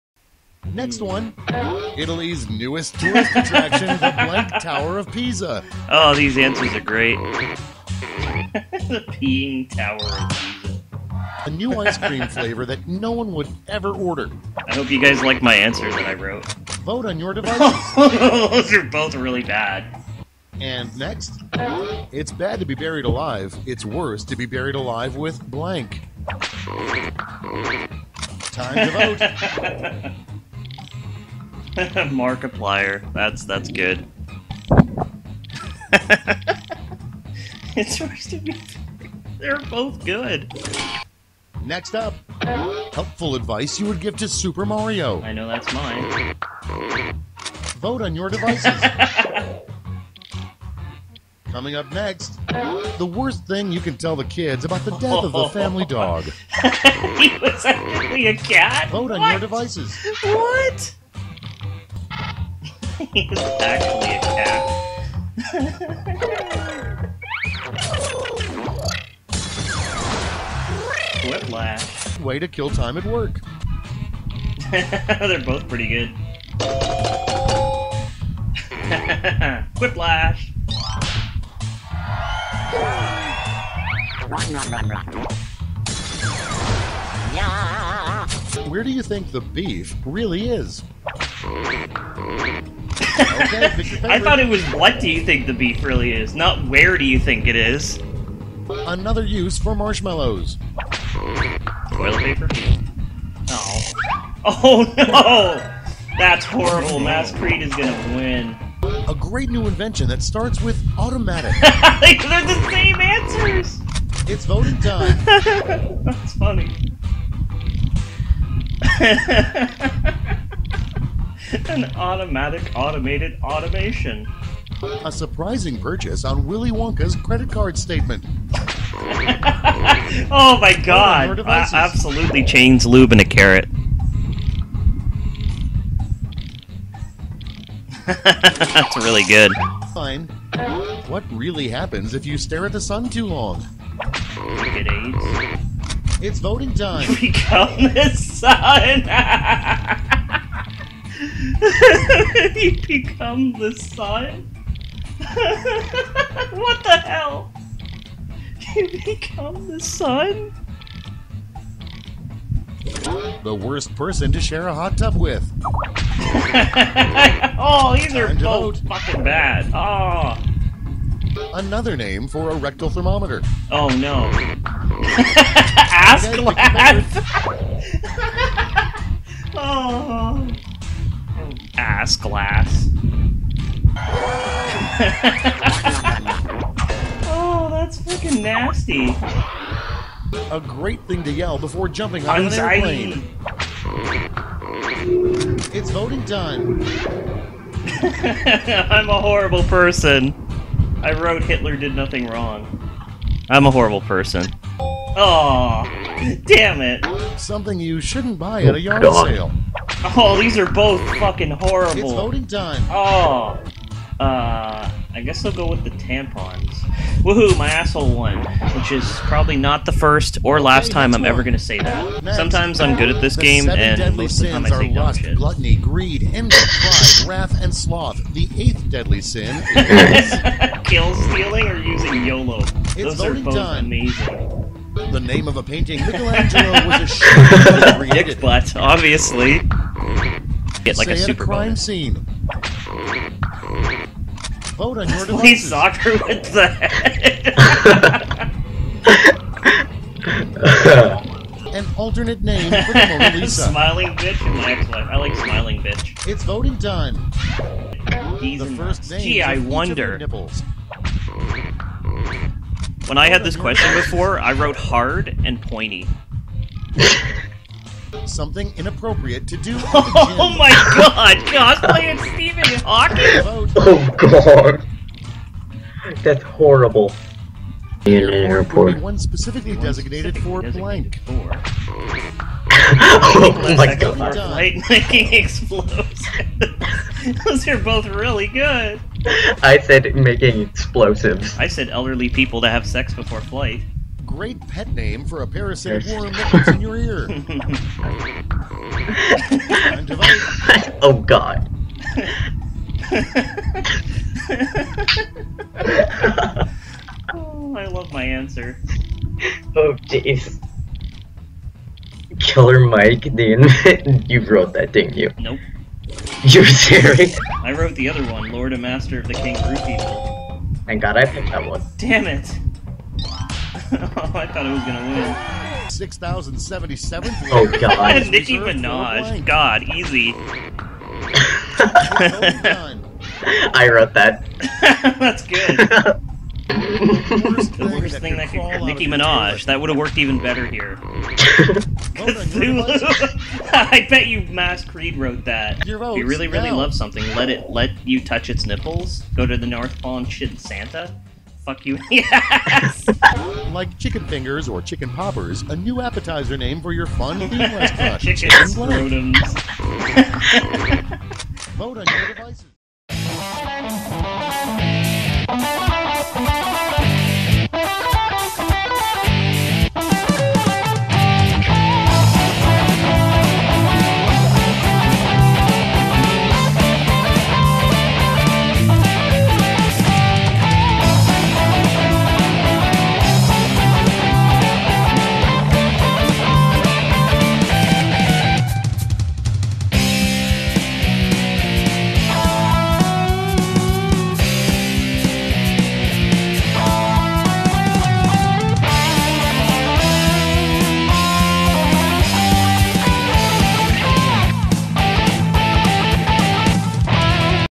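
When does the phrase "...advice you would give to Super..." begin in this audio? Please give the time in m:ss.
0:43.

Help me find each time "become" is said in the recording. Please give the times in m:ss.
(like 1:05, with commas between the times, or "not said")
2:27, 2:32, 2:39.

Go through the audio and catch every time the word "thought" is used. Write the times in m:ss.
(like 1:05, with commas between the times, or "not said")
1:34, 5:24.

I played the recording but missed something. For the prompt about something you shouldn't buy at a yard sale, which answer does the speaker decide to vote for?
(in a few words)
Tampons.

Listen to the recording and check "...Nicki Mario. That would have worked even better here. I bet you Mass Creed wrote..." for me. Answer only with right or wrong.
wrong.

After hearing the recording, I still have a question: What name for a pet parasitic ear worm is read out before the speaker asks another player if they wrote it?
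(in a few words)
Killer Mike.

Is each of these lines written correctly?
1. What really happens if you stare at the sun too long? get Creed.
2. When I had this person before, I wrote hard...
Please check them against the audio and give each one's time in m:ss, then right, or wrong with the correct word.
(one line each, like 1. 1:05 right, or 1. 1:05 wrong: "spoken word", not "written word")
1. 2:21 wrong: "AIDS", not "Creed"
2. 4:23 wrong: "question", not "person".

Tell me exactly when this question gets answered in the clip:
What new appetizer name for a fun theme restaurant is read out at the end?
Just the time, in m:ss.
5:58.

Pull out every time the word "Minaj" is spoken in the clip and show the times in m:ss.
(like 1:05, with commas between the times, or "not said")
5:28, 5:39.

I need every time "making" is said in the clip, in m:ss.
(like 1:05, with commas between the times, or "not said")
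4:44, 4:50.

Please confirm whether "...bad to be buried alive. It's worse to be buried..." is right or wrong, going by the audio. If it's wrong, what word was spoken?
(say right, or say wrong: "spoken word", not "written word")
right.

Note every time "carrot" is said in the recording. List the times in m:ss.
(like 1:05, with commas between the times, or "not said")
2:13.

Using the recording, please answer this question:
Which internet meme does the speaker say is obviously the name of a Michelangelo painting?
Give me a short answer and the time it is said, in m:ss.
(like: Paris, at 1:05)
Dick butt, at 3:58.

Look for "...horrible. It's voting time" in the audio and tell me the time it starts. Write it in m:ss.
3:31.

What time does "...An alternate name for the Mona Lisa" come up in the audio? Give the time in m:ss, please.
4:11.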